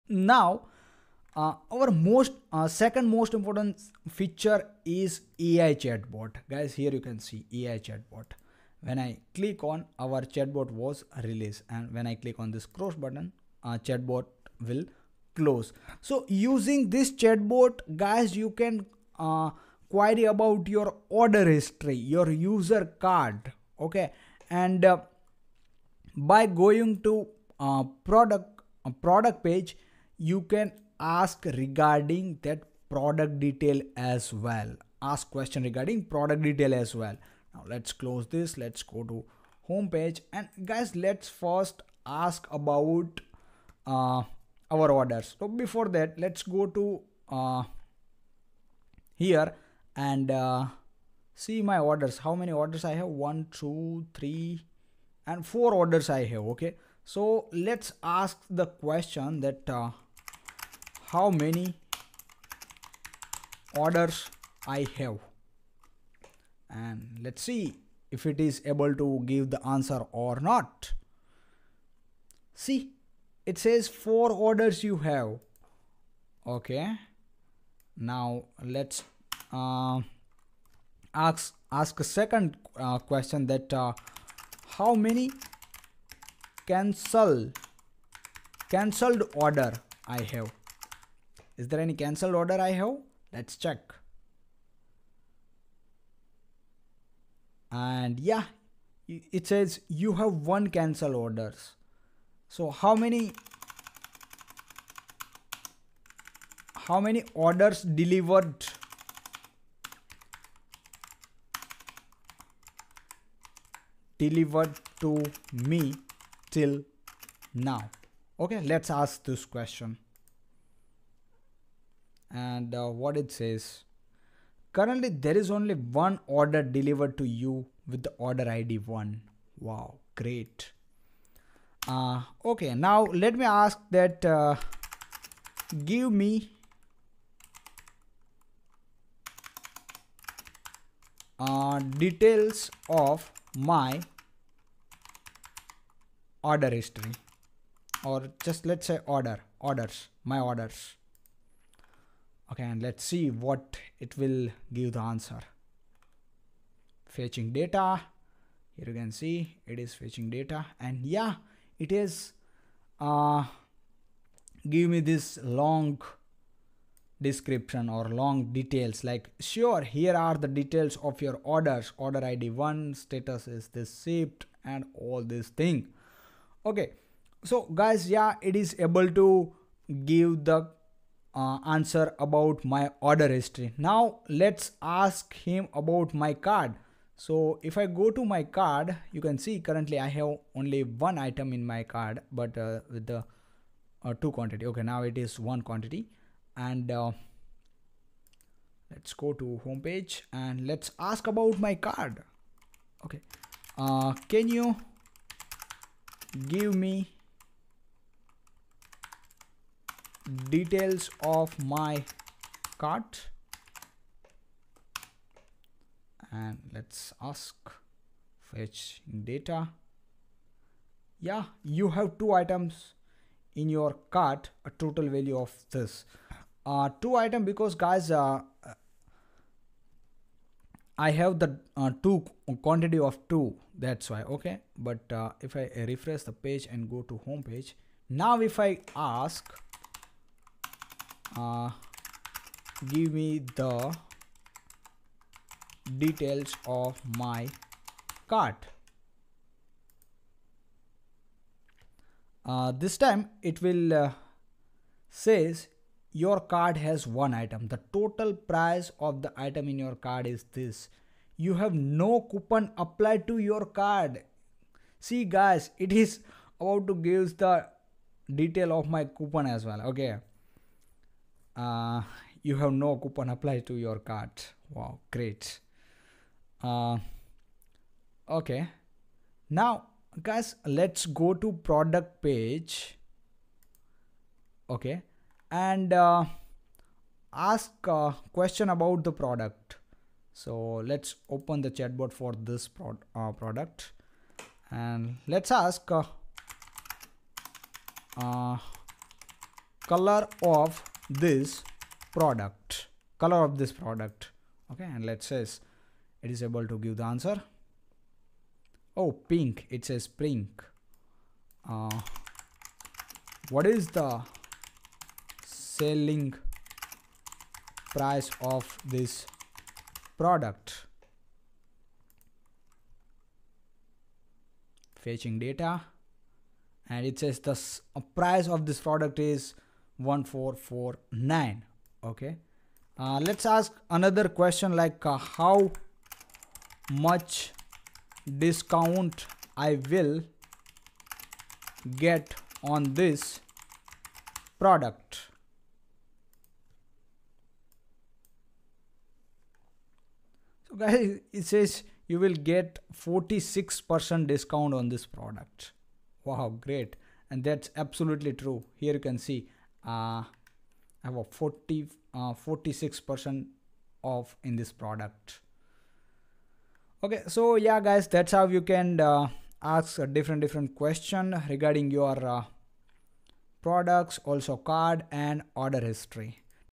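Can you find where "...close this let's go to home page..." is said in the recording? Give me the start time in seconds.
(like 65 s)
38 s.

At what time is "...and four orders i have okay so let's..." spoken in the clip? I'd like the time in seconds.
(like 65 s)
55 s.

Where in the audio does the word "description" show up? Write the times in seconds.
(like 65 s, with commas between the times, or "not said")
167 s.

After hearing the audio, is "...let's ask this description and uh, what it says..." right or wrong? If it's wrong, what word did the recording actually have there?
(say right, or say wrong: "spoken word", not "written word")
wrong: "question", not "description".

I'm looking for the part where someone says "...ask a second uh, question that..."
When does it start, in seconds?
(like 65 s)
81 s.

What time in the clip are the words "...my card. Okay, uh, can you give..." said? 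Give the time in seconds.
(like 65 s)
201 s.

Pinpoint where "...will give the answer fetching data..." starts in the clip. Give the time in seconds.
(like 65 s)
154 s.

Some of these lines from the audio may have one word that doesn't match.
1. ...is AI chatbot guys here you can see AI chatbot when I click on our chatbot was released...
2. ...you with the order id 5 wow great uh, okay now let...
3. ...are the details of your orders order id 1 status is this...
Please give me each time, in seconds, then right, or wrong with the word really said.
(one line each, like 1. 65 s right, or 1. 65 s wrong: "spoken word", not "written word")
1. 4 s right
2. 127 s wrong: "1", not "5"
3. 170 s right.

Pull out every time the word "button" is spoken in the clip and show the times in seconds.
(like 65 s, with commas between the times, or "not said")
12 s.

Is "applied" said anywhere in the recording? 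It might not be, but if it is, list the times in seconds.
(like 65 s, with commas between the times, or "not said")
262 s, 273 s.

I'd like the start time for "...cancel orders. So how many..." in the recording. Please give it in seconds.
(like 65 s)
100 s.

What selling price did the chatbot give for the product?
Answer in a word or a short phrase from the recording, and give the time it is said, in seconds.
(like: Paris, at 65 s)
1449, at 330 s.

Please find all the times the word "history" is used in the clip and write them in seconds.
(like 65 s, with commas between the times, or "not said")
21 s, 146 s, 183 s, 375 s.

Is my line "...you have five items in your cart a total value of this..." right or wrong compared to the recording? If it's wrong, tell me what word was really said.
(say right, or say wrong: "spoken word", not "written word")
wrong: "two", not "five".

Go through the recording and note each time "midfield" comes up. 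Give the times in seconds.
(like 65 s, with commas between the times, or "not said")
not said.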